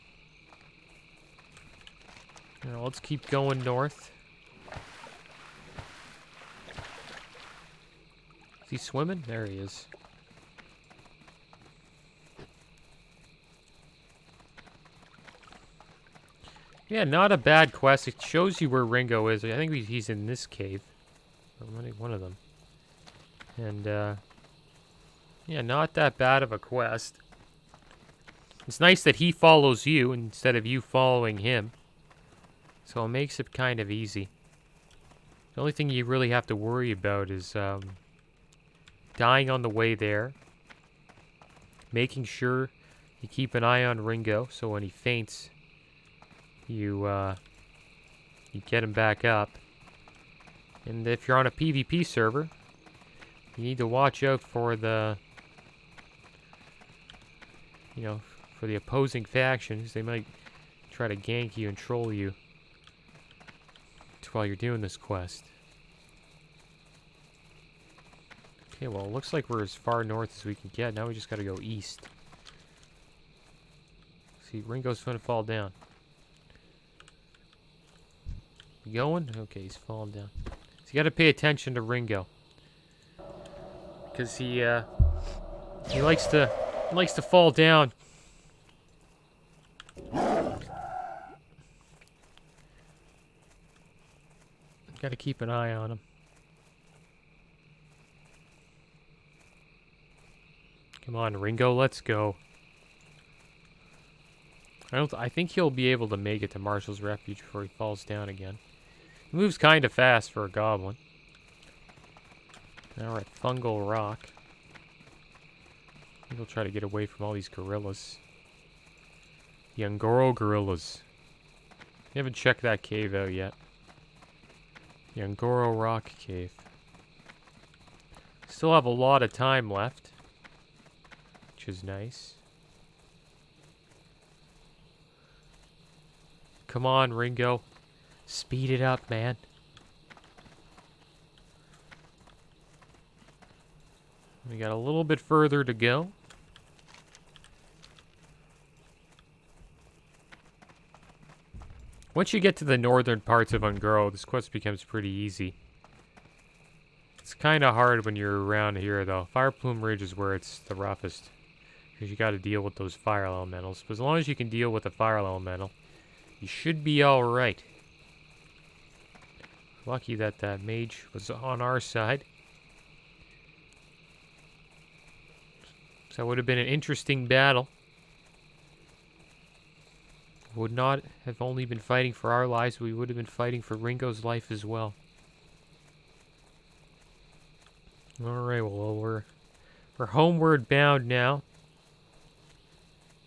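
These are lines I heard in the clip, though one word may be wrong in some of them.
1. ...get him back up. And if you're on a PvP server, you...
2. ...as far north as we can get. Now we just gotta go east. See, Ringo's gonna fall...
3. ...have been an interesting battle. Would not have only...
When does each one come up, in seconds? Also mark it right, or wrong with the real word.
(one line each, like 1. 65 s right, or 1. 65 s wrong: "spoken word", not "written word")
1. 48 s right
2. 69 s right
3. 176 s right.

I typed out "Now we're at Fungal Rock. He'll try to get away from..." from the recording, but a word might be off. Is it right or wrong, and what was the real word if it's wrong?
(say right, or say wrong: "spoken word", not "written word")
right.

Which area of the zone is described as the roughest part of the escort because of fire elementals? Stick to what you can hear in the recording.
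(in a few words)
Fireplume Ridge.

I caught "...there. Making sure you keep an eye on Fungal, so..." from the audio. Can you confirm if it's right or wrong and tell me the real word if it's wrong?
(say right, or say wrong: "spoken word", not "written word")
wrong: "Ringo", not "Fungal".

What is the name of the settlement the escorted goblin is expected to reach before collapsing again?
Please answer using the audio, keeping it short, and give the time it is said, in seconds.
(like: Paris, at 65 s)
Marshal's Refuge, at 106 s.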